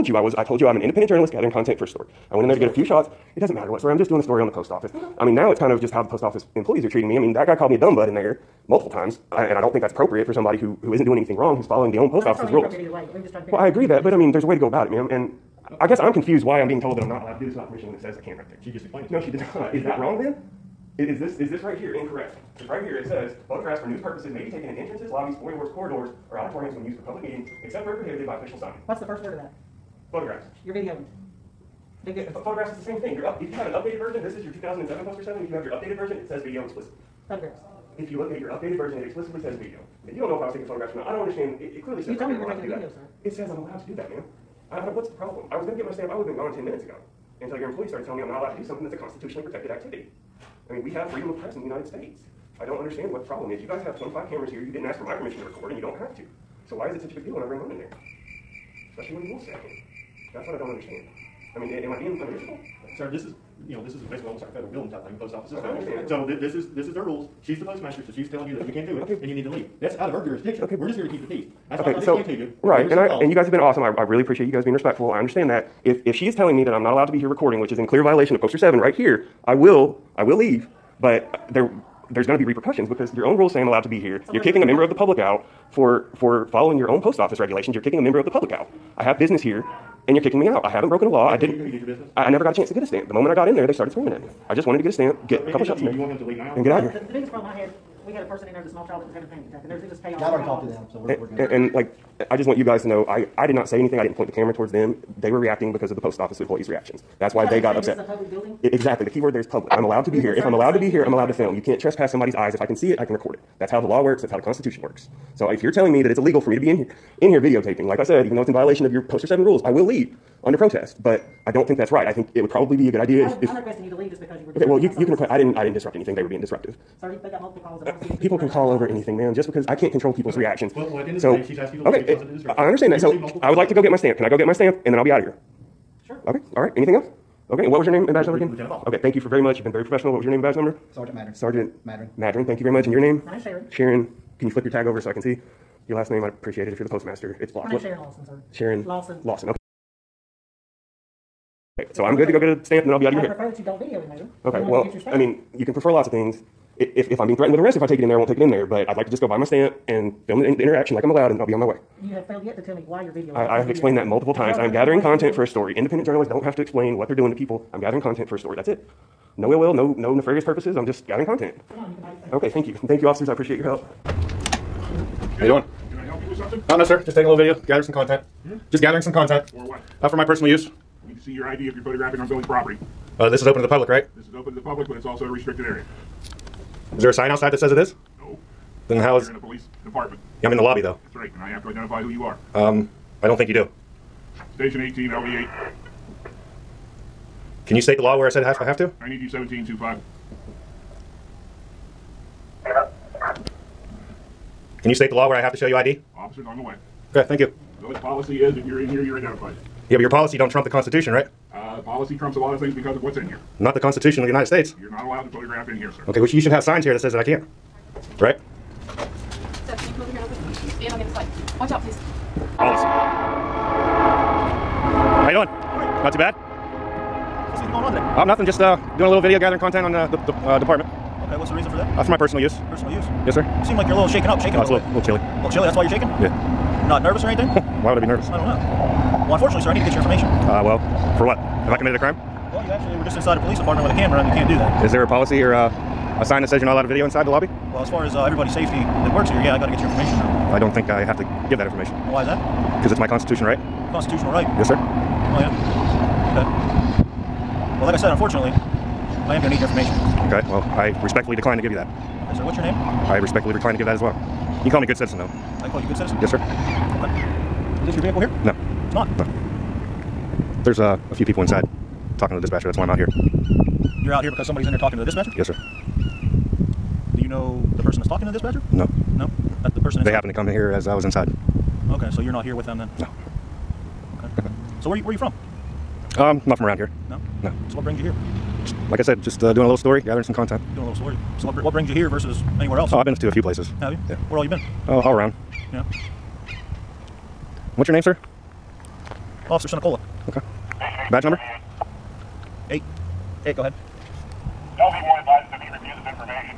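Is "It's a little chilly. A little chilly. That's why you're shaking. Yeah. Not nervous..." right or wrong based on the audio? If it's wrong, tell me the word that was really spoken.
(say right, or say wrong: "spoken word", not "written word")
right.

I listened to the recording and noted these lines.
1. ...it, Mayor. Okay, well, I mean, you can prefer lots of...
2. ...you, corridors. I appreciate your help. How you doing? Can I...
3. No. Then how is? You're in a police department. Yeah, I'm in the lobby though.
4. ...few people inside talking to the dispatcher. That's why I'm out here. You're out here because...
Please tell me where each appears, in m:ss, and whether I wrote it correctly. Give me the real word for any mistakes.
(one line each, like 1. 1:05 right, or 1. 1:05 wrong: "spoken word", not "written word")
1. 2:34 right
2. 2:53 wrong: "officers", not "corridors"
3. 3:08 right
4. 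4:31 right.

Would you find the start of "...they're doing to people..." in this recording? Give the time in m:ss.
2:47.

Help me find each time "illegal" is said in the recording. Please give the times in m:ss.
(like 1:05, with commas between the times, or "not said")
1:56.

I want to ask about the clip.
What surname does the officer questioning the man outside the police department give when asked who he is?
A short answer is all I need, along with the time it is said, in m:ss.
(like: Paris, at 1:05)
Sinicola, at 4:59.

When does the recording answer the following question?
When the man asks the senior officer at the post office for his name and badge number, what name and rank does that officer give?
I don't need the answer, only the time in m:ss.
2:18.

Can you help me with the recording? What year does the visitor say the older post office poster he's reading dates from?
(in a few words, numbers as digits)
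2007.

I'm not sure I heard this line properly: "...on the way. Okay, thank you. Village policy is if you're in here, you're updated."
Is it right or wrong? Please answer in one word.
wrong.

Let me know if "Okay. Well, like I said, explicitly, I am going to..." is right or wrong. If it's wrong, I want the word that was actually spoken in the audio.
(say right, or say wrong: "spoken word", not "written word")
wrong: "unfortunately", not "explicitly".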